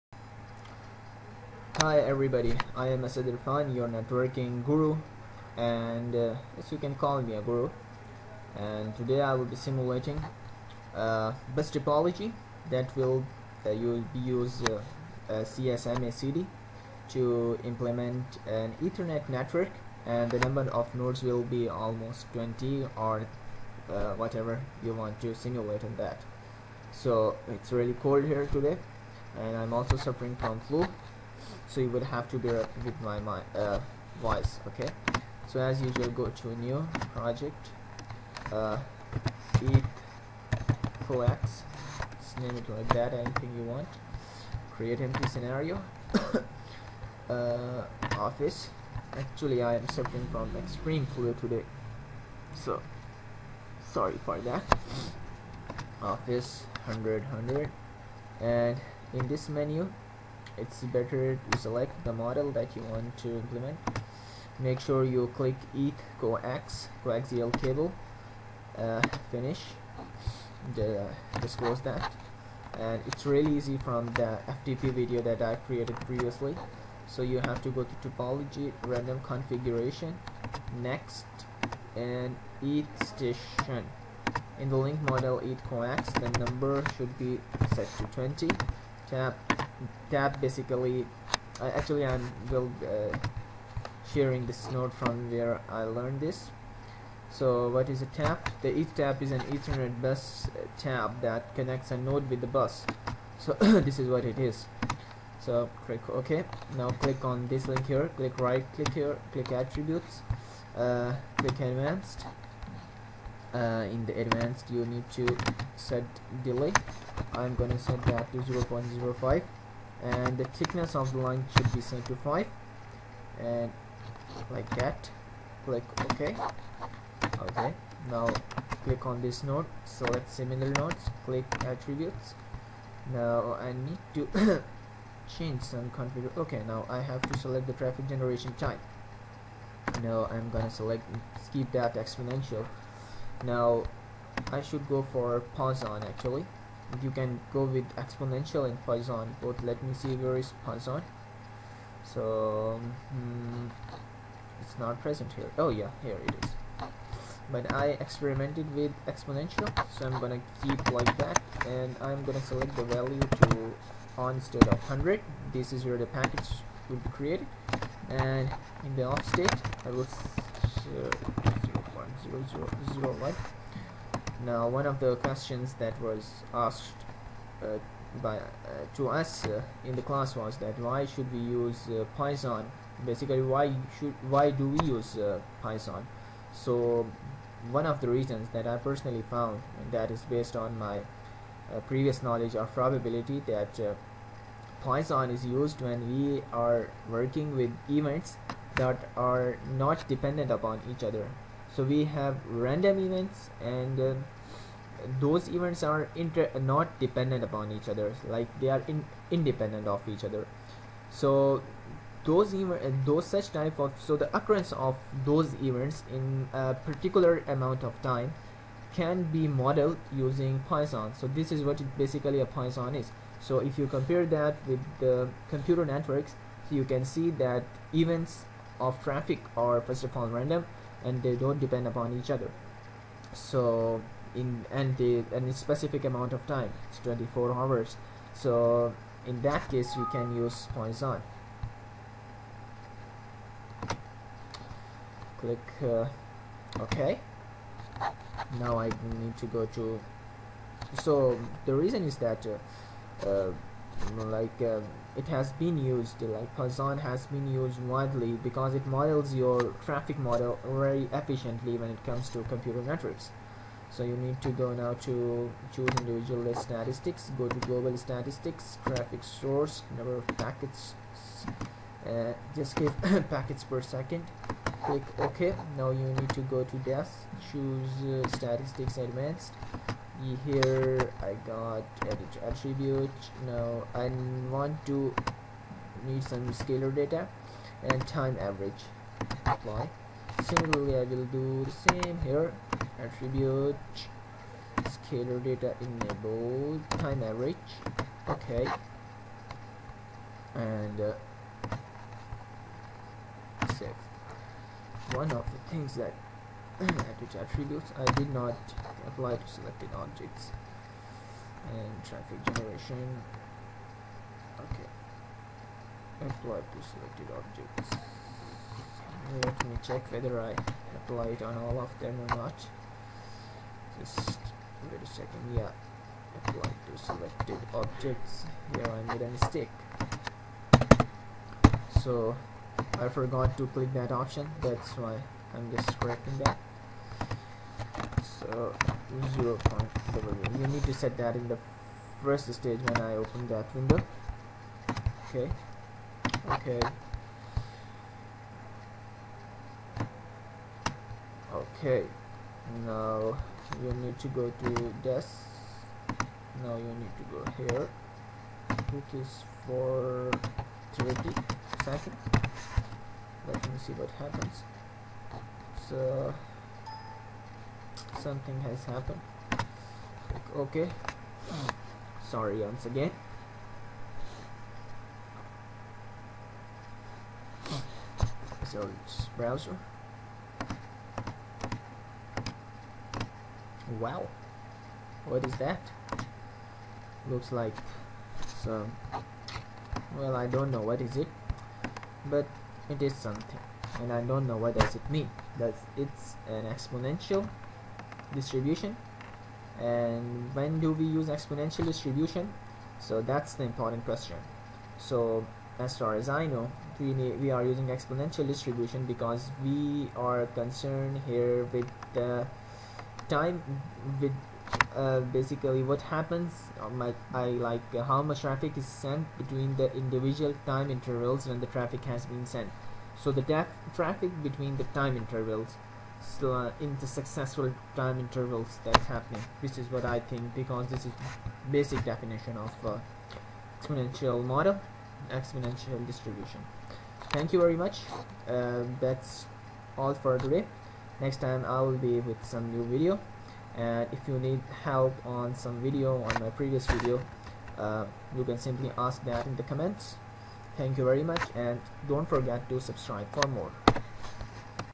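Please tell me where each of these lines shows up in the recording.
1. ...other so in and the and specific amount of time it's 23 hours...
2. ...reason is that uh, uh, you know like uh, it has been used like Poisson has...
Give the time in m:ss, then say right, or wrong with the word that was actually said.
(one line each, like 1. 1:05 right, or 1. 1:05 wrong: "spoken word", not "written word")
1. 3:52 wrong: "24", not "23"
2. 4:11 right.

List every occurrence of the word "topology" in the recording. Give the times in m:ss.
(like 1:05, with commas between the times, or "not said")
0:11, 1:18.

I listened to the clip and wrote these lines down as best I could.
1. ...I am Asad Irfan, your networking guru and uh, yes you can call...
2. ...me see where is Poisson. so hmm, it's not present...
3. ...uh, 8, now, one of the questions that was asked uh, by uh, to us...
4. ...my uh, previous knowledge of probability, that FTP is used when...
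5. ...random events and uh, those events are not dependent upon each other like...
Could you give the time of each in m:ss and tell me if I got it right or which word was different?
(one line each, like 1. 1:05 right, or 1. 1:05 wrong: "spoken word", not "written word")
1. 0:02 right
2. 2:29 right
3. 2:50 wrong: "0", not "8"
4. 3:10 wrong: "Poisson", not "FTP"
5. 3:22 right.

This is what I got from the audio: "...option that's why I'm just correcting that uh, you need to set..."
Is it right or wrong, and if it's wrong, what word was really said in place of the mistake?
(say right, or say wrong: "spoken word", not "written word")
right.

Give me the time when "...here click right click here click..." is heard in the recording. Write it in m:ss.
1:47.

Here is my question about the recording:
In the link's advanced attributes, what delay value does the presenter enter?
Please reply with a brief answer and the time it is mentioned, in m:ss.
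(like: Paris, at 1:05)
0.05, at 1:58.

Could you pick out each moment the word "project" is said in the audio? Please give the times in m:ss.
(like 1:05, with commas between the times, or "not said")
0:37.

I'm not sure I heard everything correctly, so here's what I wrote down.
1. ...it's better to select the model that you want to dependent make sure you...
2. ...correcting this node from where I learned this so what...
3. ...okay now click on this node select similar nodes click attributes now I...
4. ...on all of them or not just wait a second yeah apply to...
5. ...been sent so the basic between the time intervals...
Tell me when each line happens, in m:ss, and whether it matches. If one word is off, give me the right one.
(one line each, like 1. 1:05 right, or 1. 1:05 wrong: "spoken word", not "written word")
1. 1:00 wrong: "implement", not "dependent"
2. 1:34 wrong: "sharing", not "correcting"
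3. 2:07 right
4. 5:21 right
5. 7:02 wrong: "traffic", not "basic".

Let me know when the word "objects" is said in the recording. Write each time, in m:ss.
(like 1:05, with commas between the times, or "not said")
5:09, 5:17, 5:27.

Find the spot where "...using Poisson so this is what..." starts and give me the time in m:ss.
3:40.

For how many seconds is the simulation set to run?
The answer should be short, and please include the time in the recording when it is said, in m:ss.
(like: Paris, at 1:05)
30, at 6:00.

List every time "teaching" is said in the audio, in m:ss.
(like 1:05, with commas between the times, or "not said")
not said.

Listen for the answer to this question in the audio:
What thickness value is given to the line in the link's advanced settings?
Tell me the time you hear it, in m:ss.
2:01.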